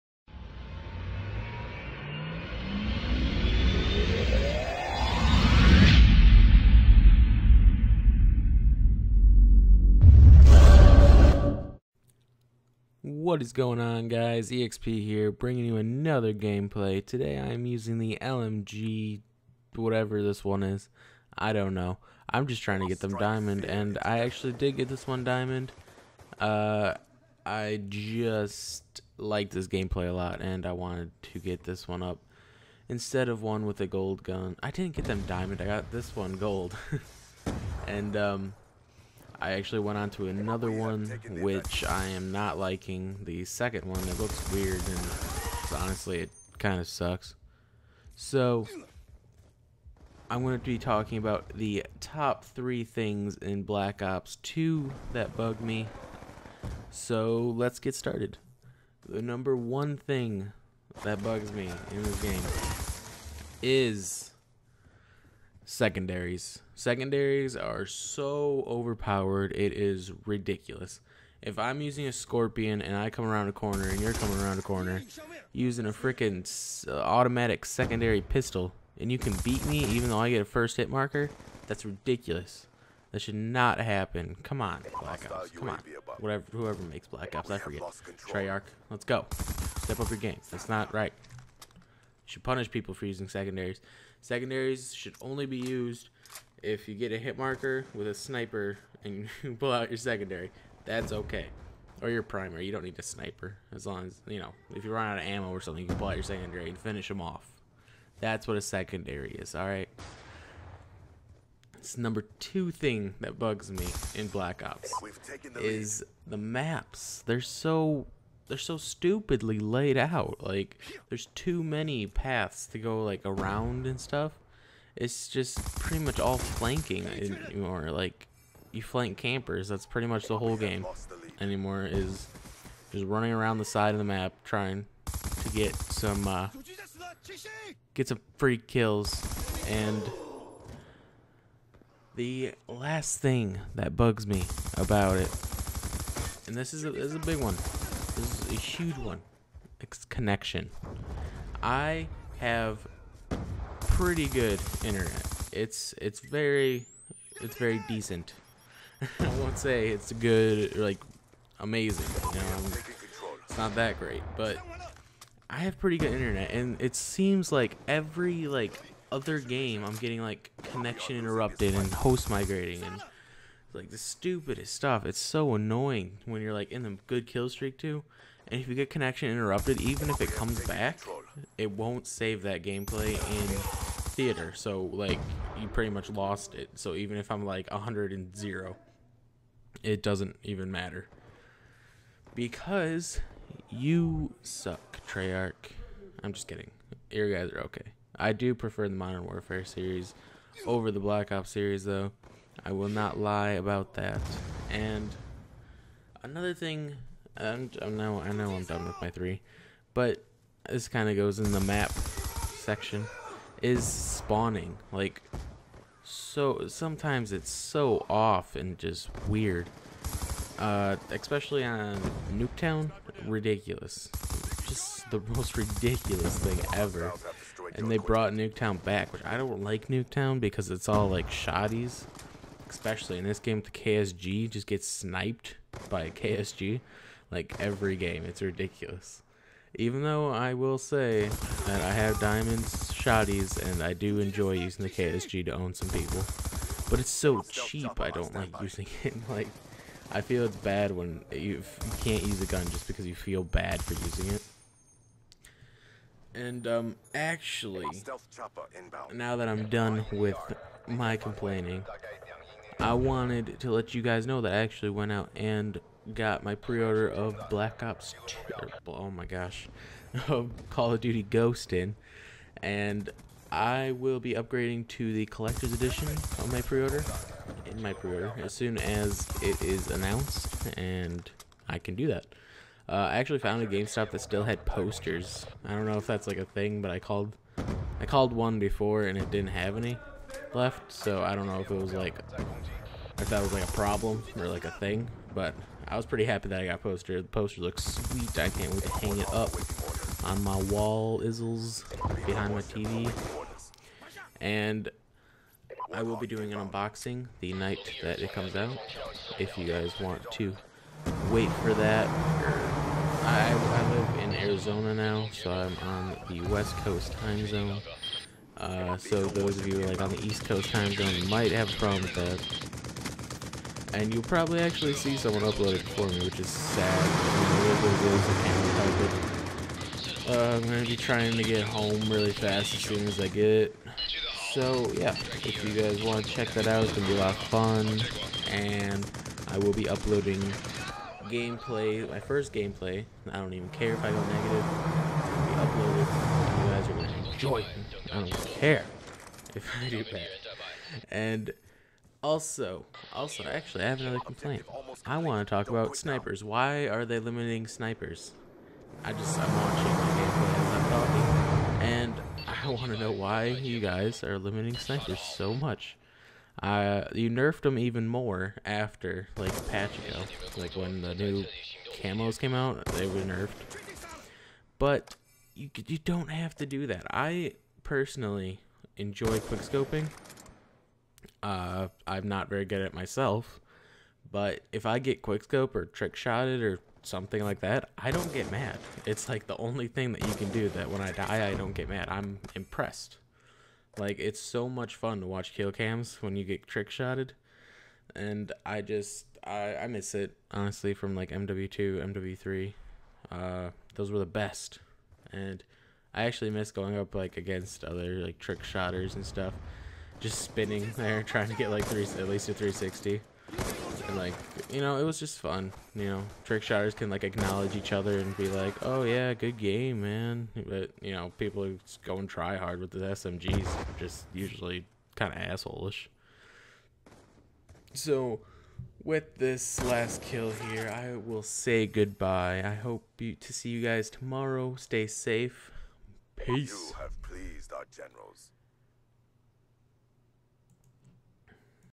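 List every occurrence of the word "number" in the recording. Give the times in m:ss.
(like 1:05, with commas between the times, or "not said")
0:59, 1:51.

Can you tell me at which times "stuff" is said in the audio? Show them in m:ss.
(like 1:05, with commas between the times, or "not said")
2:03, 2:54, 6:49.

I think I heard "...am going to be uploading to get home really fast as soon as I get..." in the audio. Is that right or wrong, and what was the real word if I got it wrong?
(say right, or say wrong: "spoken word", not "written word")
wrong: "trying", not "uploading".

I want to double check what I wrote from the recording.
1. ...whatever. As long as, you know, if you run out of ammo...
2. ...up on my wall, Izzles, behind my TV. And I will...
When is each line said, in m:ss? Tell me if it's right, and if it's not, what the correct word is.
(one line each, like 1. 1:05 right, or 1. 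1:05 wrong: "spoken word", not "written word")
1. 1:43 wrong: "sniper", not "whatever"
2. 4:59 right.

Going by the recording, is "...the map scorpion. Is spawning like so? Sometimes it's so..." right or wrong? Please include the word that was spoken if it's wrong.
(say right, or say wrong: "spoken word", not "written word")
wrong: "section", not "scorpion".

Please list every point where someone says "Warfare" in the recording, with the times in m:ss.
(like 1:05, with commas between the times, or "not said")
3:19.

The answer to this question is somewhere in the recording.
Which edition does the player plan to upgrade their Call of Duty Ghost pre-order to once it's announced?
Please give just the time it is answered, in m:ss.
4:35.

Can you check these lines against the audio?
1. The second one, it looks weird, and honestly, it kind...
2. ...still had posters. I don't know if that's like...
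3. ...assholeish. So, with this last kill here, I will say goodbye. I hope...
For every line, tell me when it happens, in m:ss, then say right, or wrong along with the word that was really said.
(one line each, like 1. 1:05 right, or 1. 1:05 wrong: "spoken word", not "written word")
1. 0:43 right
2. 4:44 right
3. 7:05 right.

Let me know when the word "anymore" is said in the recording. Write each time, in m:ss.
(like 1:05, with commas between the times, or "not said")
2:07, 2:11.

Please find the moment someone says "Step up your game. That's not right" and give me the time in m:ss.
1:29.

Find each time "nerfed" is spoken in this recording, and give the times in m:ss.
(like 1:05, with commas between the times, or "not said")
6:07, 6:13.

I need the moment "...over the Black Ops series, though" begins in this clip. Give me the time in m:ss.
3:20.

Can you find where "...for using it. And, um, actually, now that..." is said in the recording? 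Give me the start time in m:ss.
4:13.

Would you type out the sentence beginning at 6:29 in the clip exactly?
It's like the only thing that you can do that when I die, I don't get mad.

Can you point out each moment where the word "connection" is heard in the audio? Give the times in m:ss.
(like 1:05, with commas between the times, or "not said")
2:30, 2:50, 2:58.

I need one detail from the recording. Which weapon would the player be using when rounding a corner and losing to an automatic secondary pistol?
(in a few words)
Scorpion.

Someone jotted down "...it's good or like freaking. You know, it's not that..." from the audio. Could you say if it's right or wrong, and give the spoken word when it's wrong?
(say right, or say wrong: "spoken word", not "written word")
wrong: "amazing", not "freaking".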